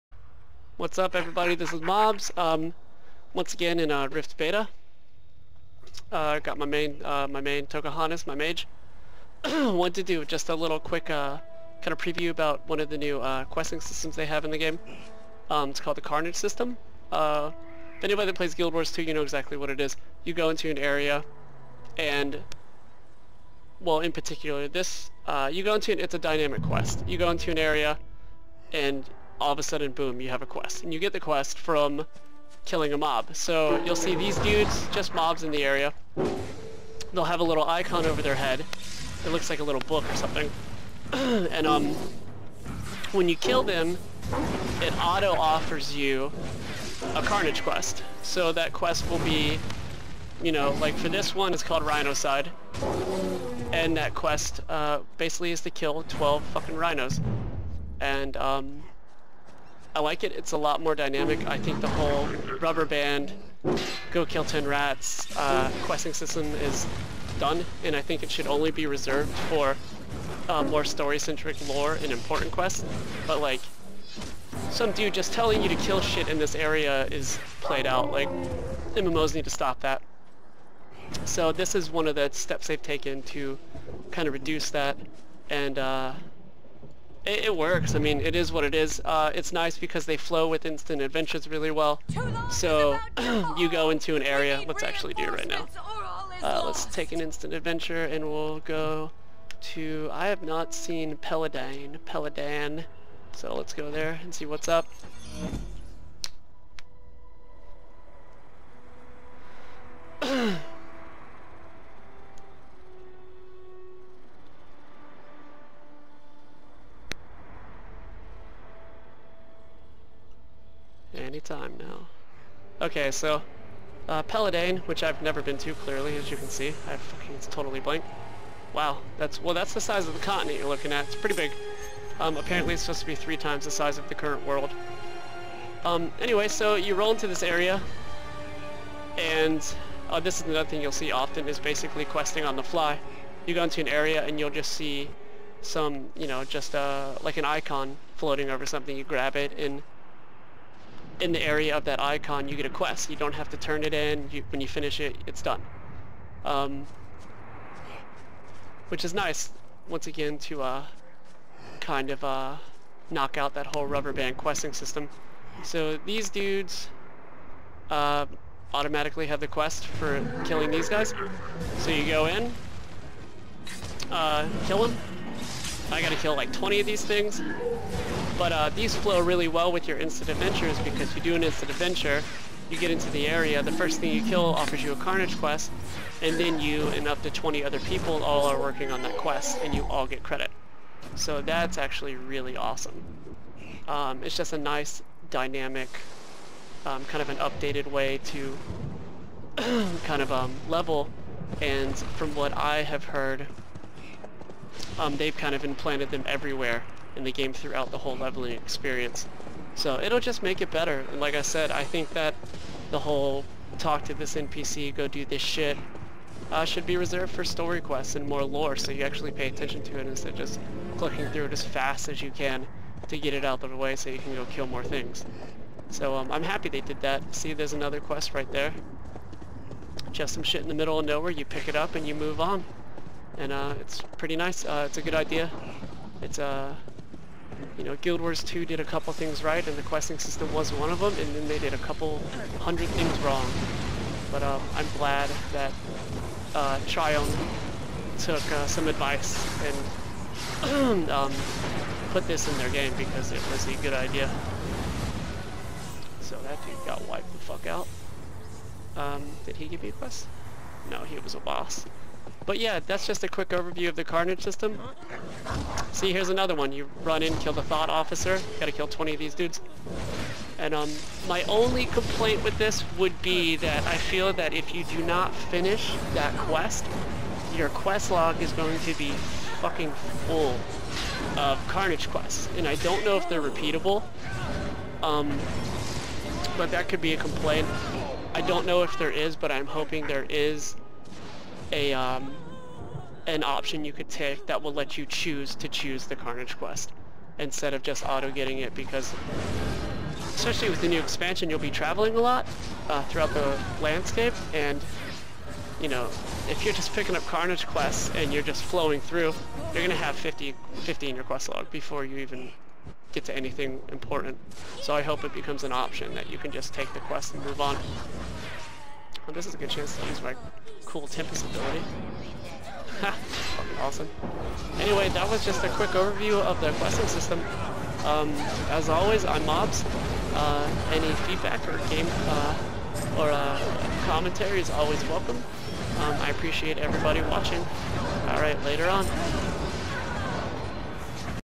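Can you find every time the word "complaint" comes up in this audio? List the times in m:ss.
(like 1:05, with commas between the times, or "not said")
4:31, 4:47.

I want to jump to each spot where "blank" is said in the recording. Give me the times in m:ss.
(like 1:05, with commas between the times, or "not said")
2:07.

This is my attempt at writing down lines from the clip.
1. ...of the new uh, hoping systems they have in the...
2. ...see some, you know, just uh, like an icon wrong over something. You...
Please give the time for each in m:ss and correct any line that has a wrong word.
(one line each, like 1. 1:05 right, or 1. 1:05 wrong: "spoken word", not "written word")
1. 0:12 wrong: "questing", not "hoping"
2. 2:24 wrong: "floating", not "wrong".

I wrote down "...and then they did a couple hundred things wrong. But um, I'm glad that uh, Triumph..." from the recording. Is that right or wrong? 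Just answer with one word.
right.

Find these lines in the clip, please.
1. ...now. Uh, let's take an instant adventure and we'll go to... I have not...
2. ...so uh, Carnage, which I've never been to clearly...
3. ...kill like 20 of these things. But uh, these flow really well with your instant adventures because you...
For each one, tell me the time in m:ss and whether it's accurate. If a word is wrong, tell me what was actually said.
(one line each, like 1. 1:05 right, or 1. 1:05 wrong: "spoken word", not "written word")
1. 1:35 right
2. 2:03 wrong: "Pelladane", not "Carnage"
3. 2:56 right.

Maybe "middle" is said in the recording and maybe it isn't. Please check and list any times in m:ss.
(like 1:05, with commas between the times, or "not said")
3:50.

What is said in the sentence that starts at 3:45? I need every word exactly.
So um, I'm happy they did that.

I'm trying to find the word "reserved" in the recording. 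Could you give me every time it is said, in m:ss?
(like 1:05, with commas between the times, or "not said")
1:08, 3:36.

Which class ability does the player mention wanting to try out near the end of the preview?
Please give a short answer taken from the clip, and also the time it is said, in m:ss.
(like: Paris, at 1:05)
Tempest, at 5:21.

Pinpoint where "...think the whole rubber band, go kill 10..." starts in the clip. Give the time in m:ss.
1:01.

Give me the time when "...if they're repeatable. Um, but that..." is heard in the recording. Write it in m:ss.
4:43.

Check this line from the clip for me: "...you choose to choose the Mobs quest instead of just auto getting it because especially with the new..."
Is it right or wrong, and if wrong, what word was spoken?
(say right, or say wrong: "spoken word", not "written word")
wrong: "Carnage", not "Mobs".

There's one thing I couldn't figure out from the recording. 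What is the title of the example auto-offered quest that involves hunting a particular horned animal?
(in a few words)
Rhinocide.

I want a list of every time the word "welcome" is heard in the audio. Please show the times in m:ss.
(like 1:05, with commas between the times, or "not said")
5:35.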